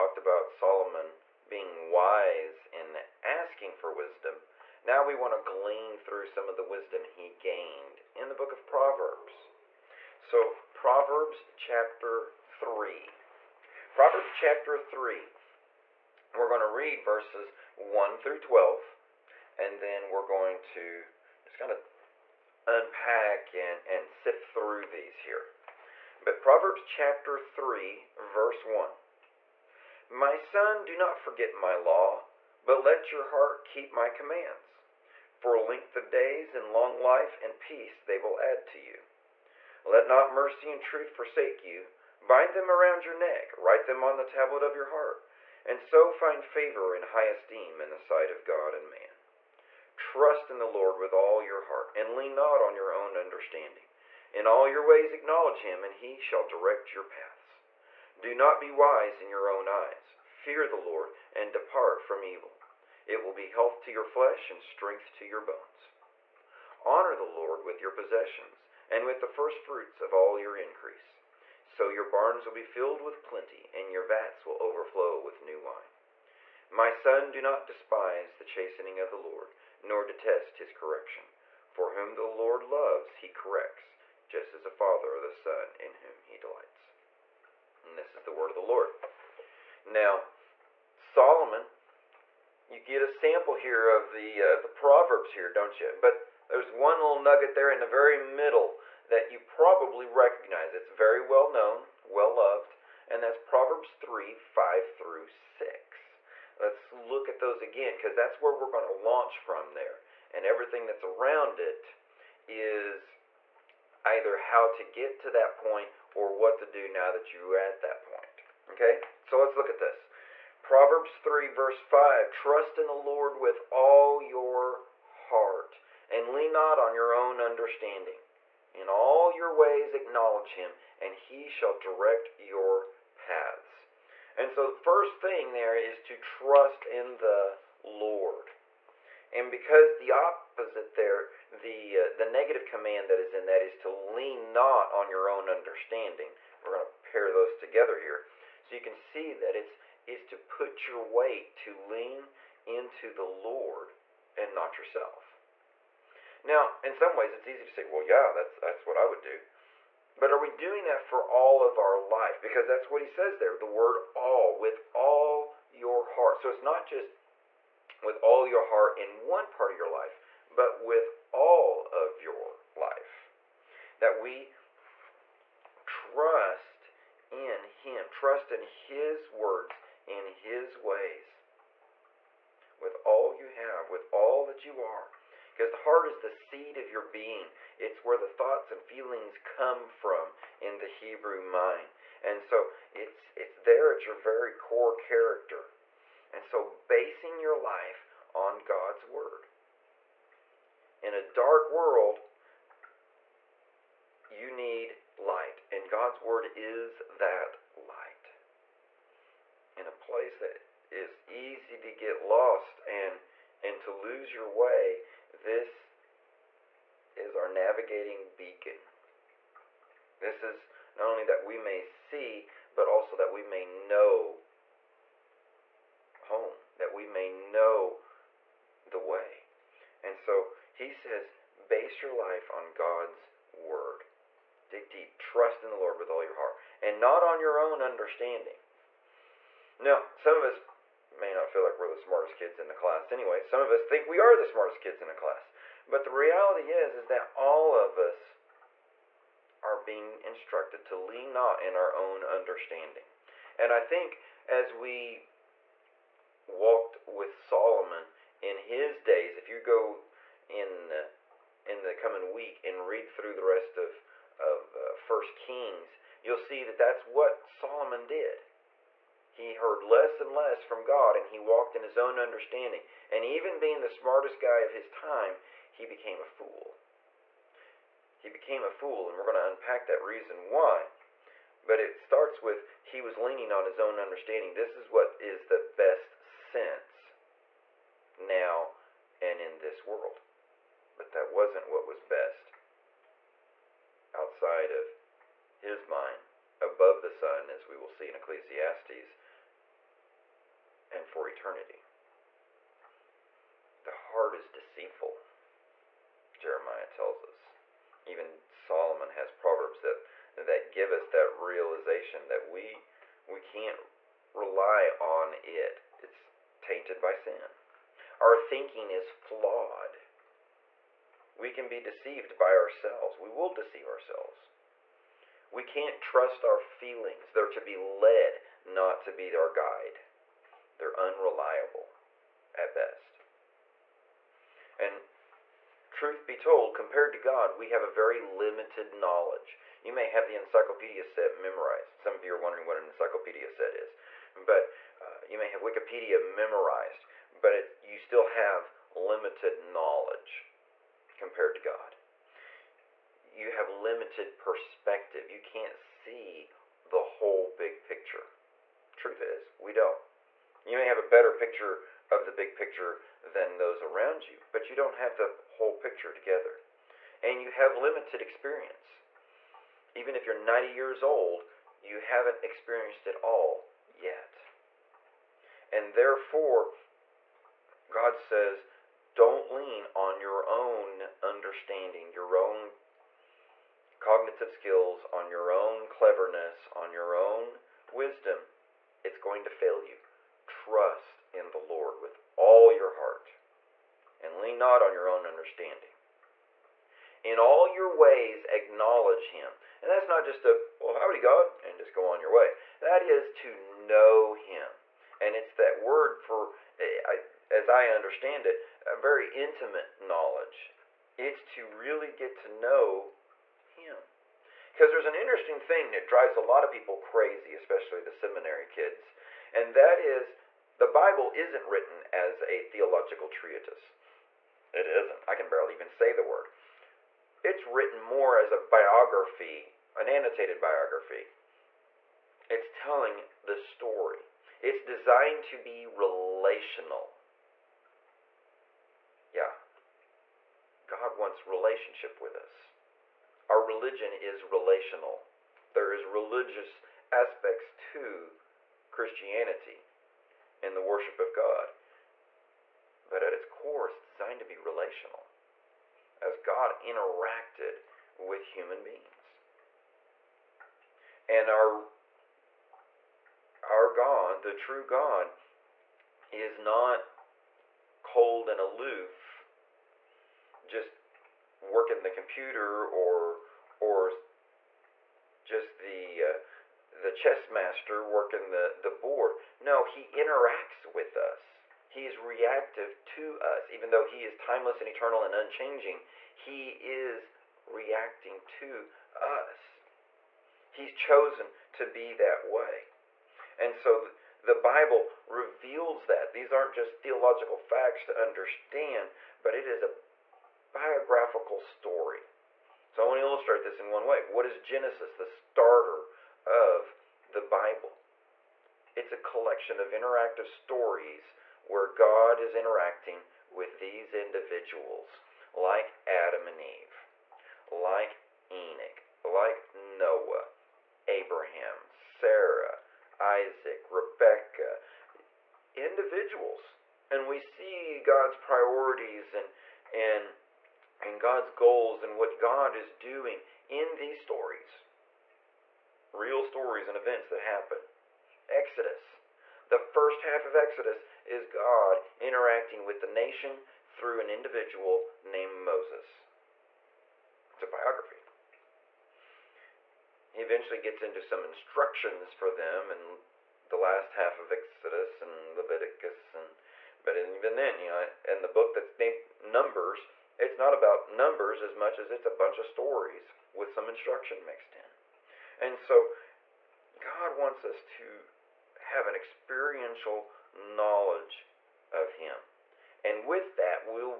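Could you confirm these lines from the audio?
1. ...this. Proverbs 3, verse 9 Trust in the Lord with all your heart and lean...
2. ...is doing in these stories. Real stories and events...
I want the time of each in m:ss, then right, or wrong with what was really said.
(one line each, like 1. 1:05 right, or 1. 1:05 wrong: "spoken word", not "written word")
1. 1:59 wrong: "5", not "9"
2. 8:52 right.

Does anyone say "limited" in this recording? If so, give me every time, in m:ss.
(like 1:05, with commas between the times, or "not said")
5:38, 5:48, 5:53, 6:07.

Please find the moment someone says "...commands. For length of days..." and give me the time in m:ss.
0:34.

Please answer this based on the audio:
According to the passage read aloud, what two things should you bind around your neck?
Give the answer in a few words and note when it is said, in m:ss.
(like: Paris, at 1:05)
Mercy and truth, at 0:40.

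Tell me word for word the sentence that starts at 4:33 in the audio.
And even being the smartest guy of his time, he became a fool.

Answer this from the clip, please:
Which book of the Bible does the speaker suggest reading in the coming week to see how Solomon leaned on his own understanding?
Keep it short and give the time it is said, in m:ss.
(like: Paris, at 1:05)
First Kings, at 4:24.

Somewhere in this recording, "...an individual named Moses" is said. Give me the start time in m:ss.
9:04.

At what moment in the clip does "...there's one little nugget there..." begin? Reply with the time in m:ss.
1:36.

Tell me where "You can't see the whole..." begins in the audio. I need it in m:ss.
5:55.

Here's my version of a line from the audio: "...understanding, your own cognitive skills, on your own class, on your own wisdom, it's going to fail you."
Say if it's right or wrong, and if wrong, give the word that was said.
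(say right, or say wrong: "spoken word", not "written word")
wrong: "cleverness", not "class".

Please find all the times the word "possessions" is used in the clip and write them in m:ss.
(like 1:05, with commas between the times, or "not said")
1:07.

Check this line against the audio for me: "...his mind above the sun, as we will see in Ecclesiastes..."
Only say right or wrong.
right.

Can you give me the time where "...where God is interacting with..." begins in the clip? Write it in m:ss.
8:31.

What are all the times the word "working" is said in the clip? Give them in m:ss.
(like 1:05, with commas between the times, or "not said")
7:51, 7:58.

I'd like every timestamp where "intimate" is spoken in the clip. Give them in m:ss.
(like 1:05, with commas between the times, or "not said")
6:49.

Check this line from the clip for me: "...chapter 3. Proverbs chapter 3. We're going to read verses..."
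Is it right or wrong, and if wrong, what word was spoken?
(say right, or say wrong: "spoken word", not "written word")
right.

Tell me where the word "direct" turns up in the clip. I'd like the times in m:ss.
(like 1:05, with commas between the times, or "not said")
0:56, 2:11.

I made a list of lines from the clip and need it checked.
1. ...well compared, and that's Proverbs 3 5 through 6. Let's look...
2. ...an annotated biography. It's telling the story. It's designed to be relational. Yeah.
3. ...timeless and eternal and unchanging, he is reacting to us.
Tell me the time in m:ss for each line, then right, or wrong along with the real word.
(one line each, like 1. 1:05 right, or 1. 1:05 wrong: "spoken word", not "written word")
1. 1:42 wrong: "loved", not "compared"
2. 7:09 right
3. 8:04 right.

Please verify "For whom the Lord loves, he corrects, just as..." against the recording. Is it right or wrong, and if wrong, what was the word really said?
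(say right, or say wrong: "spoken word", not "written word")
right.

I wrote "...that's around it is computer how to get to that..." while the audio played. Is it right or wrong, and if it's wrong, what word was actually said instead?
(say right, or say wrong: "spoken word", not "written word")
wrong: "either", not "computer".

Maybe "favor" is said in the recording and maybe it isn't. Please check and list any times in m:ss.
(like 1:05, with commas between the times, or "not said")
0:46.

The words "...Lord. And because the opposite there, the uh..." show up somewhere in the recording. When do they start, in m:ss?
2:17.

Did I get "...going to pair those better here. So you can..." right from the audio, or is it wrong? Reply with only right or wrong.
wrong.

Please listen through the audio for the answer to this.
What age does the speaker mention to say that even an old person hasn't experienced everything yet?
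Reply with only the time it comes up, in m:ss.
6:10.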